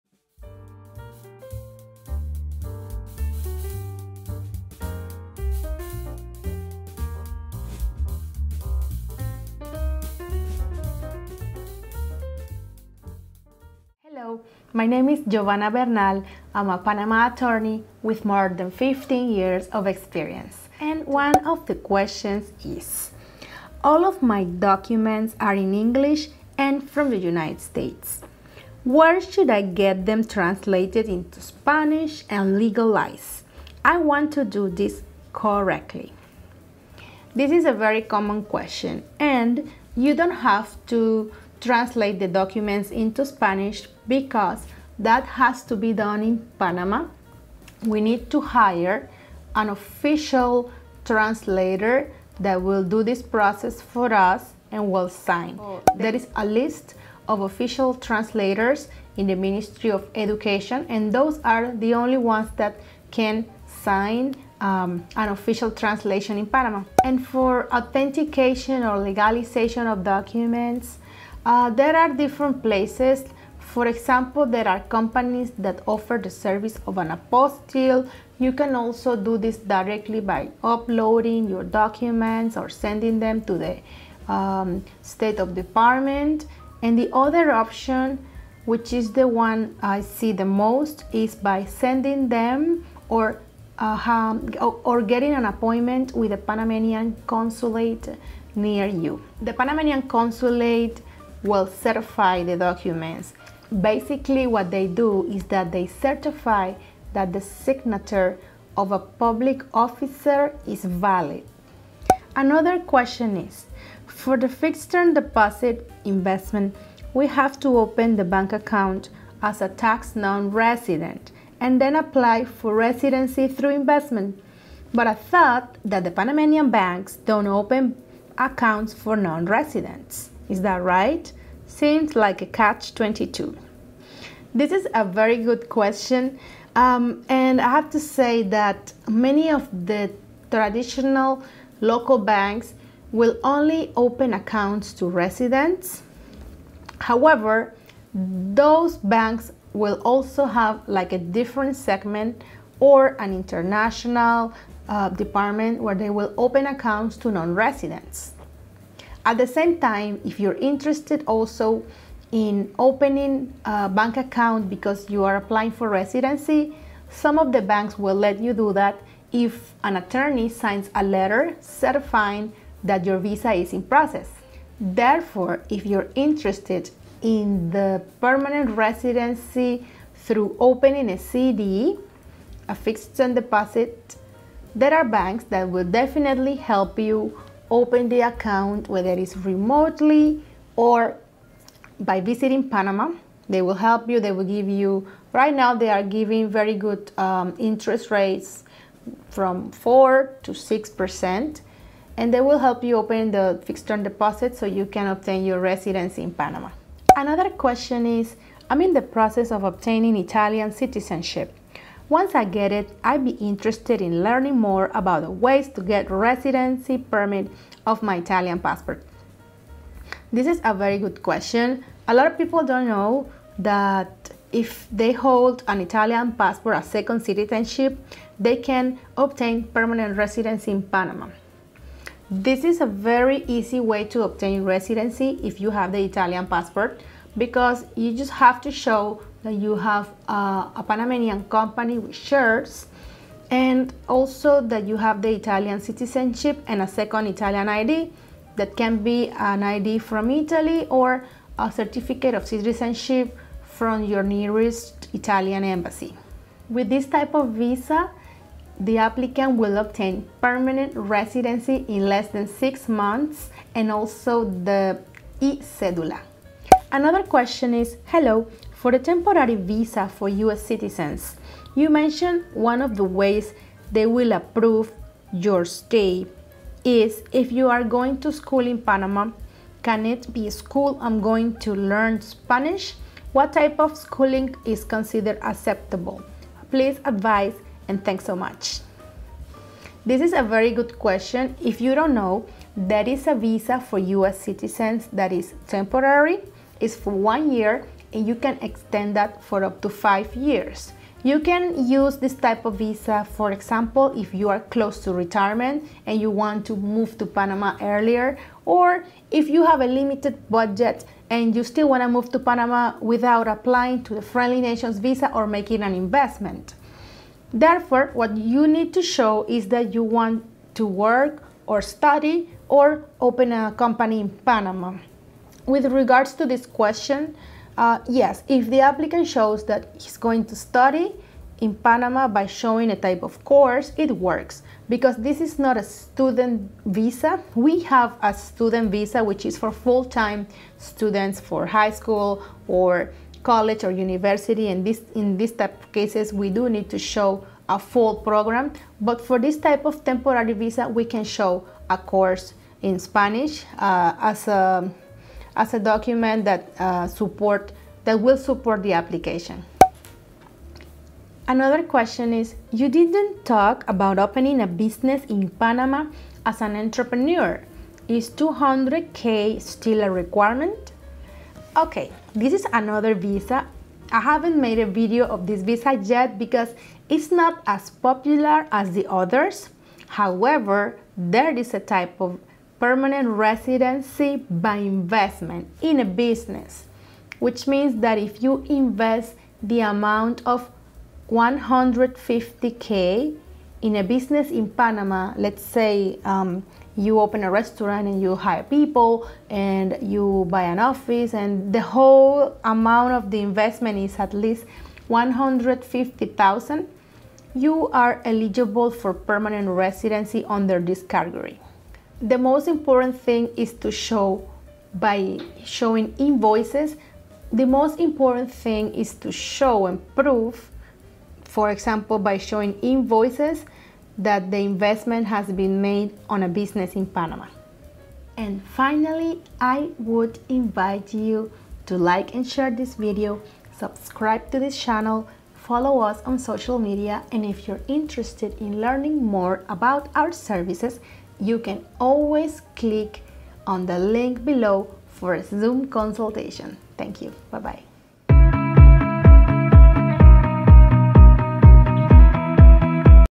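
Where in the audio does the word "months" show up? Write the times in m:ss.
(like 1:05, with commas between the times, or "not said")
4:22.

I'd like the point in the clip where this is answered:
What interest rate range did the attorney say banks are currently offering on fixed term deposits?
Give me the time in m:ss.
3:19.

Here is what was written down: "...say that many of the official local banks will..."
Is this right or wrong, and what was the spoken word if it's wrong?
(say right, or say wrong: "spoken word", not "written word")
wrong: "traditional", not "official".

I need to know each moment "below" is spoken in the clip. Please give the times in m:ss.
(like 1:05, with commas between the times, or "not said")
7:24.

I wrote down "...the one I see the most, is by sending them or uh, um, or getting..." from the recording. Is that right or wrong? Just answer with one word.
right.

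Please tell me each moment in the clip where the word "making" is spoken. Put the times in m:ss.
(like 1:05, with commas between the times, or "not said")
5:15.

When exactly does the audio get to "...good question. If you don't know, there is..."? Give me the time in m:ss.
4:50.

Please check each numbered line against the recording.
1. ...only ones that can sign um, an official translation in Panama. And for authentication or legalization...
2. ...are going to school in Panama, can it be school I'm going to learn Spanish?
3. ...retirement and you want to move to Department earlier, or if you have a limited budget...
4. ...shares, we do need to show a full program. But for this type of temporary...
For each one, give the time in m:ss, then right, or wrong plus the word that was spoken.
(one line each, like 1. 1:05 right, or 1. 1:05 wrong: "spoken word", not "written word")
1. 1:01 right
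2. 4:37 right
3. 5:05 wrong: "Panama", not "Department"
4. 5:45 wrong: "cases", not "shares".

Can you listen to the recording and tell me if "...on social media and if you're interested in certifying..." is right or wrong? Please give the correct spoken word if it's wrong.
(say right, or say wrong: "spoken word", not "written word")
wrong: "learning", not "certifying".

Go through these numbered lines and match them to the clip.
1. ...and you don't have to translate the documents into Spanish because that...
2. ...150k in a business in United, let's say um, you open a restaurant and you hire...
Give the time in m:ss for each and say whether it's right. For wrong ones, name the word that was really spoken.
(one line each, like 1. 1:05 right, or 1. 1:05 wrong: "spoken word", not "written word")
1. 0:39 right
2. 6:31 wrong: "Panama", not "United".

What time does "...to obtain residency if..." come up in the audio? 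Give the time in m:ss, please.
3:54.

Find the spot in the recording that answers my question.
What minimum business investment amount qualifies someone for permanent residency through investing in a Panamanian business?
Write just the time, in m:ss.
6:45.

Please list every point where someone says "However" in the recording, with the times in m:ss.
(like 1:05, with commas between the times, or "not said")
2:26, 6:20.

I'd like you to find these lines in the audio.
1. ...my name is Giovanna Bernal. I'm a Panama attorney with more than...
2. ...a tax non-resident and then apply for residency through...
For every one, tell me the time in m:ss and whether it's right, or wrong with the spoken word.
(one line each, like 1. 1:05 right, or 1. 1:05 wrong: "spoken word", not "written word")
1. 0:14 right
2. 1:59 right.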